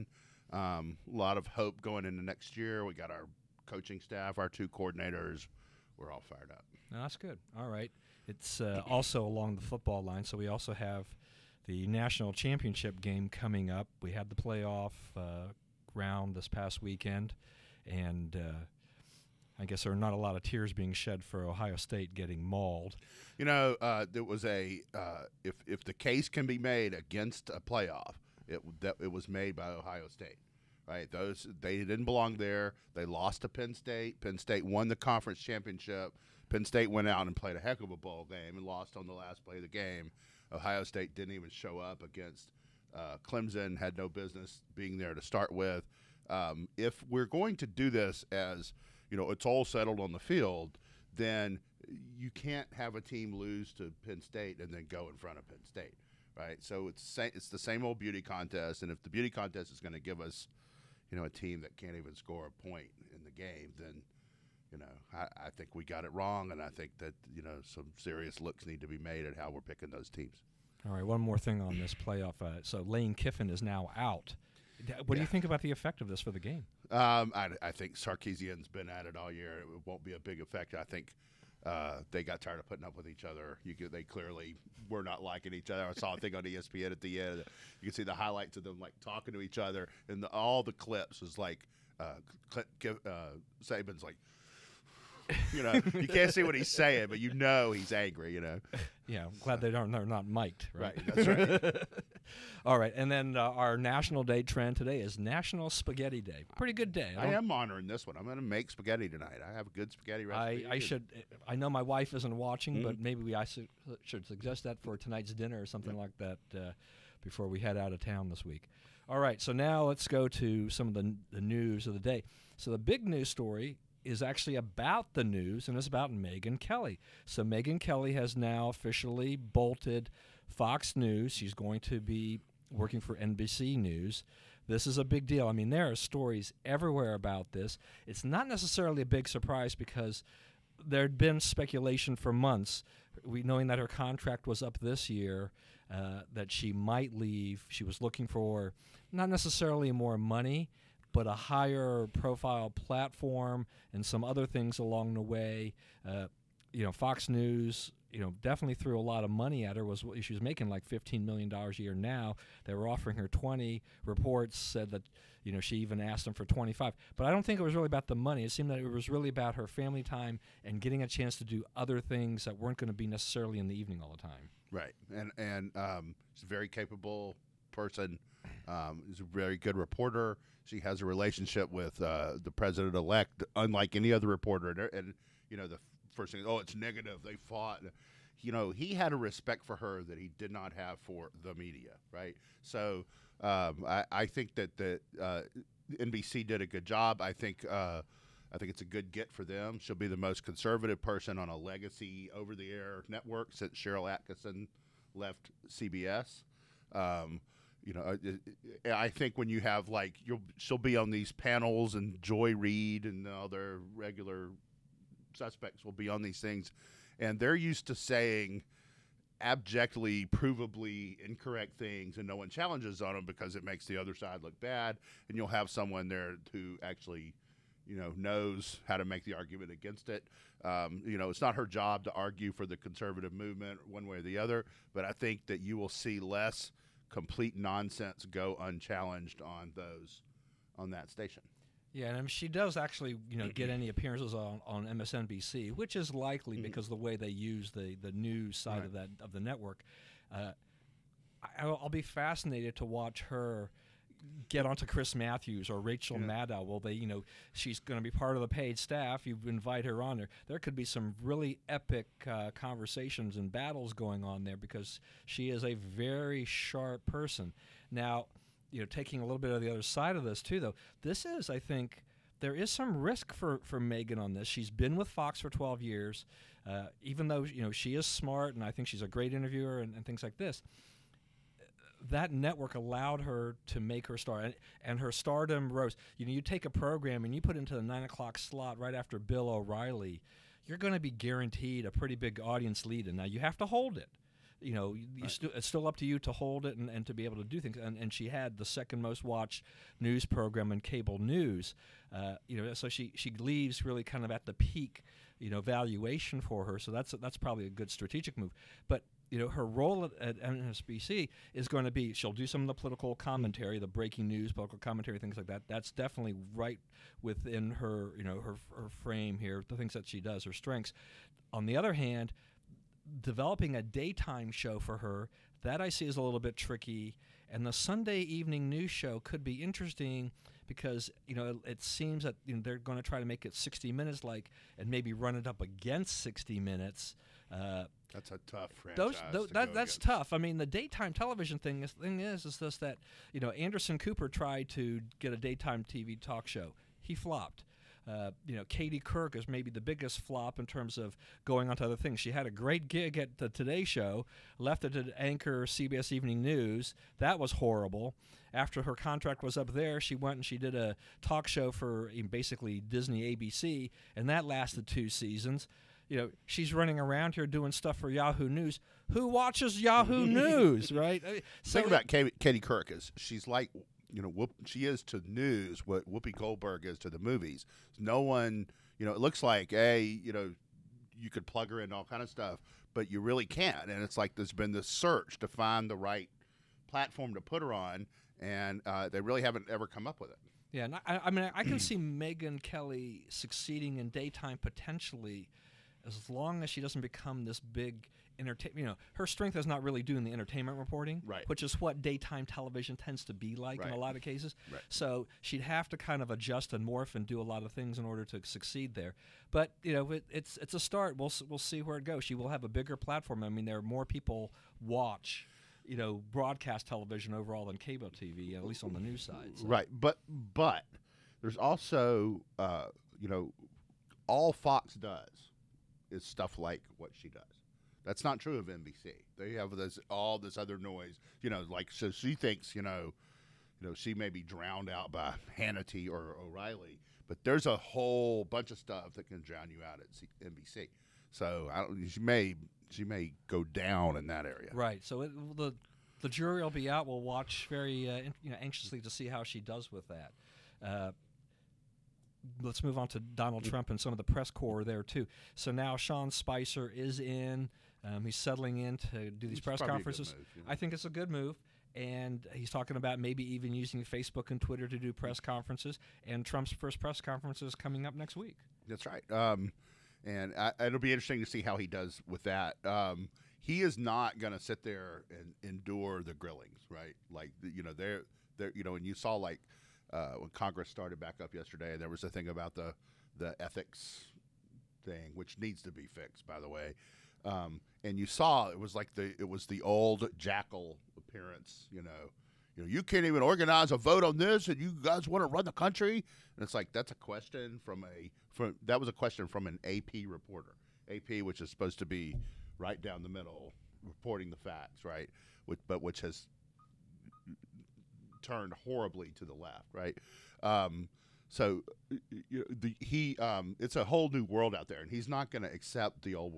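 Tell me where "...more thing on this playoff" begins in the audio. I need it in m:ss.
1:11.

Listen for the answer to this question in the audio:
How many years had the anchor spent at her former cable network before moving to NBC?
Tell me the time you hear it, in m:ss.
4:35.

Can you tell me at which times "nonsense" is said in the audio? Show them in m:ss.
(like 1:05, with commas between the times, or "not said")
3:57.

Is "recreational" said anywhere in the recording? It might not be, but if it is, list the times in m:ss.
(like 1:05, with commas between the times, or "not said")
not said.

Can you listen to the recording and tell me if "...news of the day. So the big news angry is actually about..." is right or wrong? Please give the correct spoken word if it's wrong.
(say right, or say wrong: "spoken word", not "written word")
wrong: "story", not "angry".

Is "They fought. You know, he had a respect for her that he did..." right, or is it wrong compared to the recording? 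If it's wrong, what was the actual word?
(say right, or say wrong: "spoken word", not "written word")
right.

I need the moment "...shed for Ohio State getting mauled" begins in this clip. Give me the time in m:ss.
0:20.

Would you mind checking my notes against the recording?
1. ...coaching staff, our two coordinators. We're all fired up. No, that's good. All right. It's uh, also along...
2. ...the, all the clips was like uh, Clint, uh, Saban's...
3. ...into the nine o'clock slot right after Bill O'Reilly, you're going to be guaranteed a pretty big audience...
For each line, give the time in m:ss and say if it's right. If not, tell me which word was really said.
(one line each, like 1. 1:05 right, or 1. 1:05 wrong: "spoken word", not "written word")
1. 0:03 right
2. 1:30 right
3. 4:47 right.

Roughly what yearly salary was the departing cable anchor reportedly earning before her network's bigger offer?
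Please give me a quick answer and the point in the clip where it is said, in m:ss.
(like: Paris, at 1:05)
15 million dollars, at 2:40.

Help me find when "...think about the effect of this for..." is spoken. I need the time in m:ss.
1:15.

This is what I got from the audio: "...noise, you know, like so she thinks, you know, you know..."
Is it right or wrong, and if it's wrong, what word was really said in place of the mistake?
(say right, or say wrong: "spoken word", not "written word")
right.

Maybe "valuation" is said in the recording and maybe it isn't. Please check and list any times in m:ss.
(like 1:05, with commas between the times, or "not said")
5:05.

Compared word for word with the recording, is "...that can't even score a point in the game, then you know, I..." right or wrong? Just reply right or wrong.
right.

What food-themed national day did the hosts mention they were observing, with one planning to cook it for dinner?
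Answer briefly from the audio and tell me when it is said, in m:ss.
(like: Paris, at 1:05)
National Spaghetti Day, at 1:45.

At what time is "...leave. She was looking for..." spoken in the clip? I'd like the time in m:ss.
2:27.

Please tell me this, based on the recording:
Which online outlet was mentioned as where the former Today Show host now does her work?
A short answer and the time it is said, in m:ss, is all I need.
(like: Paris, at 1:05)
Yahoo News, at 6:08.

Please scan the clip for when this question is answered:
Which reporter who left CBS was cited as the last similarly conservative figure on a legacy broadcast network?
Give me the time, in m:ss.
3:23.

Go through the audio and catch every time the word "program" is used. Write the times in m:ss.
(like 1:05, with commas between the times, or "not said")
4:46, 5:00.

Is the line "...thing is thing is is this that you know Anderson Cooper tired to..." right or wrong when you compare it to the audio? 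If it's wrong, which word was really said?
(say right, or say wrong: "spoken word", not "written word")
wrong: "tried", not "tired".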